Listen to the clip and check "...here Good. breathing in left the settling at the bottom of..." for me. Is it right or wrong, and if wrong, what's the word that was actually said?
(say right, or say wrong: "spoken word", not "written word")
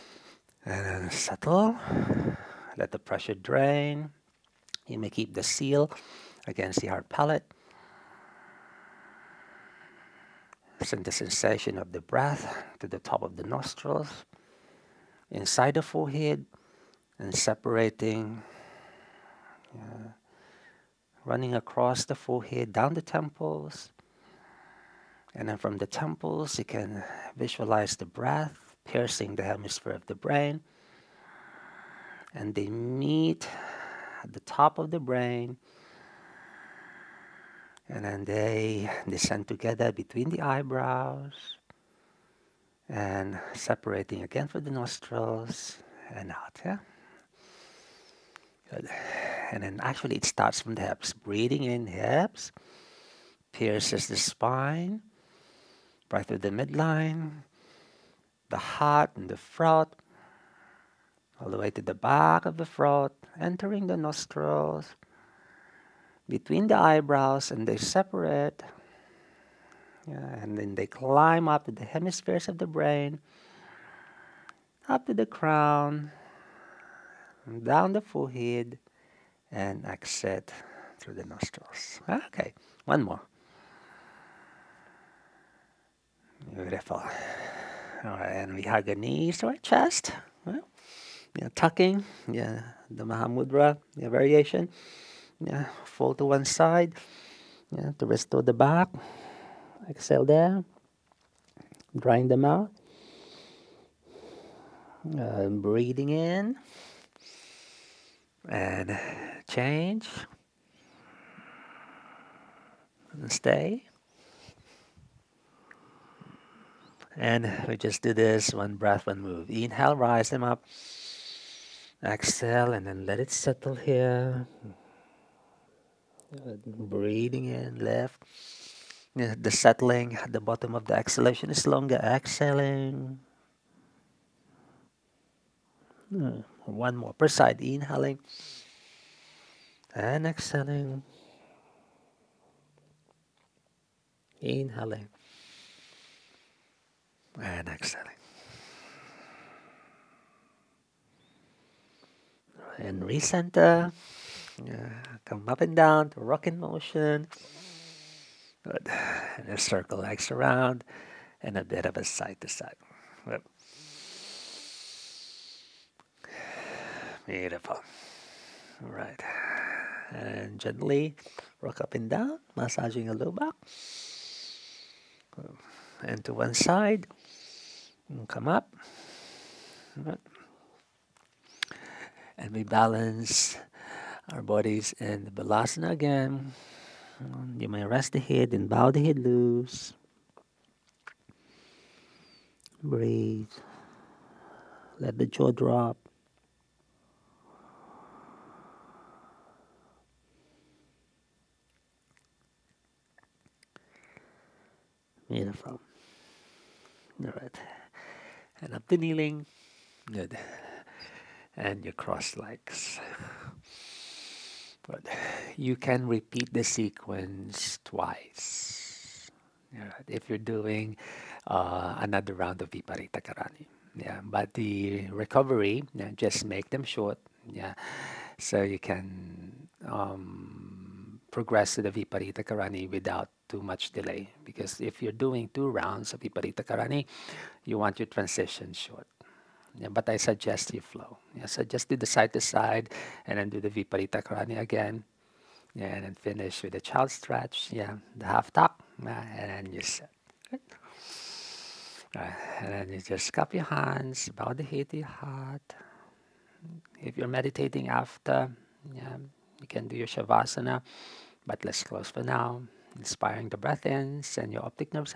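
right.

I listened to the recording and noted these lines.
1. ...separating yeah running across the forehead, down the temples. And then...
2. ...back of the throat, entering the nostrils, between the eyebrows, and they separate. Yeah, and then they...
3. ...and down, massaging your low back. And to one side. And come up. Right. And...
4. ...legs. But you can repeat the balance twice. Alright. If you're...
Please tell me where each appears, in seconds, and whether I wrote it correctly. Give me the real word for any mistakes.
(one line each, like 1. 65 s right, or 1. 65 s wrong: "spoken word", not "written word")
1. 17 s right
2. 61 s right
3. 171 s right
4. 212 s wrong: "sequence", not "balance".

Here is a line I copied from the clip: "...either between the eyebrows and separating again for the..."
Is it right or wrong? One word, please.
wrong.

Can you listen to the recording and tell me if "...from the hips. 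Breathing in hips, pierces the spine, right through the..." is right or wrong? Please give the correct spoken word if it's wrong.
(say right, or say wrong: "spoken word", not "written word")
right.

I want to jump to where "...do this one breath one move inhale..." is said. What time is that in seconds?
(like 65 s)
118 s.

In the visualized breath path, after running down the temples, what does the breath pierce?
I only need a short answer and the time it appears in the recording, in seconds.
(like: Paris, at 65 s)
Hemisphere of the brain, at 29 s.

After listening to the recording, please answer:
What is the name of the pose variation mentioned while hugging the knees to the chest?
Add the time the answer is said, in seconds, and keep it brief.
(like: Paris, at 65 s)
Mahamudra, at 93 s.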